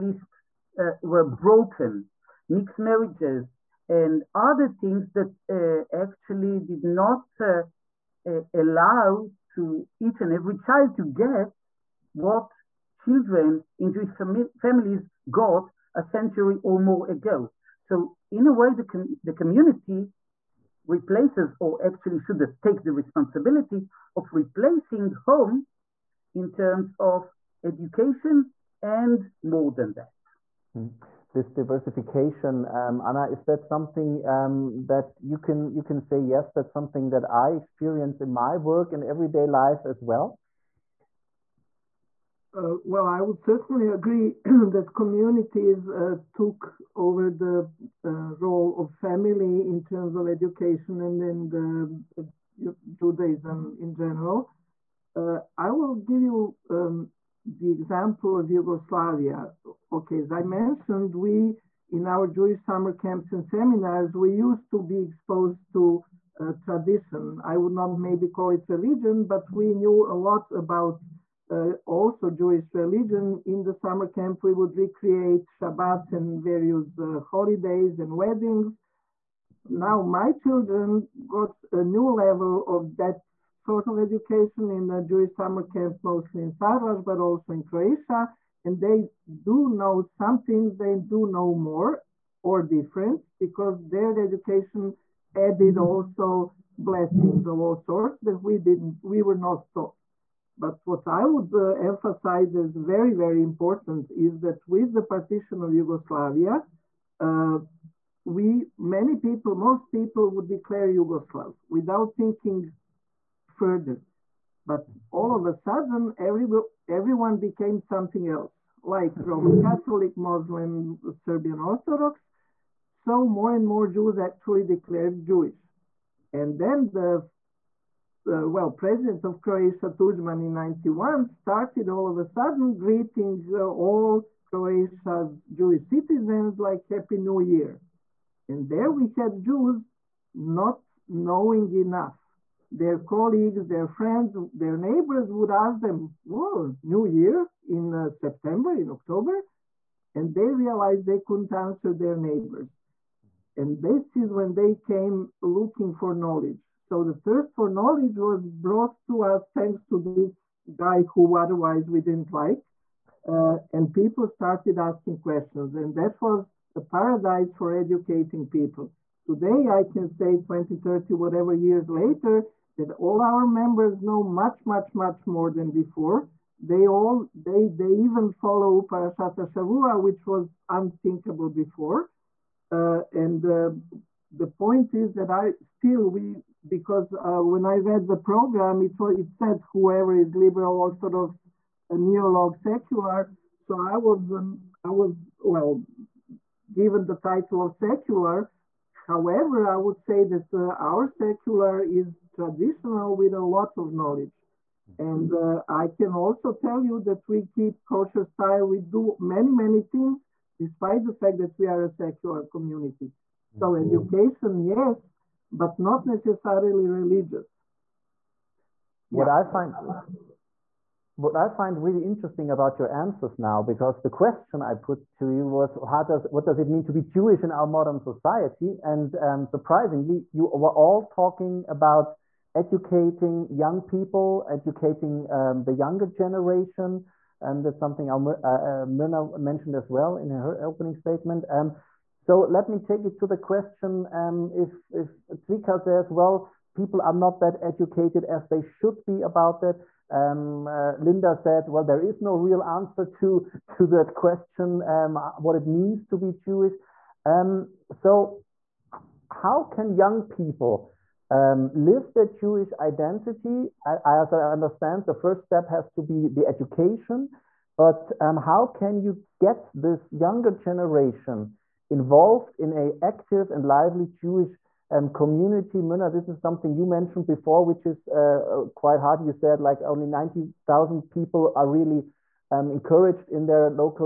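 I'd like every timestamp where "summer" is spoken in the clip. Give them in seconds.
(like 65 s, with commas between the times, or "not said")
62 s, 73 s, 85 s.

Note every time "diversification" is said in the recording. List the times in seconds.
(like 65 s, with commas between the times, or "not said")
31 s.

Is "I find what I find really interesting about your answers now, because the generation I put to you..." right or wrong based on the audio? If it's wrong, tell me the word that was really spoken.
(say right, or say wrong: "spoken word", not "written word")
wrong: "question", not "generation".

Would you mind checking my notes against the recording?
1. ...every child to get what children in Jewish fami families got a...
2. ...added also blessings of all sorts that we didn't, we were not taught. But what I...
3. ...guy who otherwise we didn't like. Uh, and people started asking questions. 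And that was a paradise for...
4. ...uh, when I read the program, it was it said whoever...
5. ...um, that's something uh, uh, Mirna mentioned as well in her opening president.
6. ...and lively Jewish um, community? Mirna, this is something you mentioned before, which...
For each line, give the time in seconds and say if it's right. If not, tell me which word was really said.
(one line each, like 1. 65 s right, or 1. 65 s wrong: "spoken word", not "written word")
1. 10 s right
2. 95 s right
3. 160 s right
4. 187 s right
5. 237 s wrong: "statement", not "president"
6. 273 s right.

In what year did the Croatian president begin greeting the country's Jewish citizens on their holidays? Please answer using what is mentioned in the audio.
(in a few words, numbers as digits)
1991.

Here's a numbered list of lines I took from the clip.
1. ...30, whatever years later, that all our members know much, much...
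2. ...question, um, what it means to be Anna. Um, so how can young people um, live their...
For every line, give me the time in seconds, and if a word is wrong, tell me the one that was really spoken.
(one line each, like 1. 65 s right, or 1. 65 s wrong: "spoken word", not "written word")
1. 170 s right
2. 254 s wrong: "Jewish", not "Anna".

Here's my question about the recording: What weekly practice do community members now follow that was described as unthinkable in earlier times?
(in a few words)
Parashat Shavua.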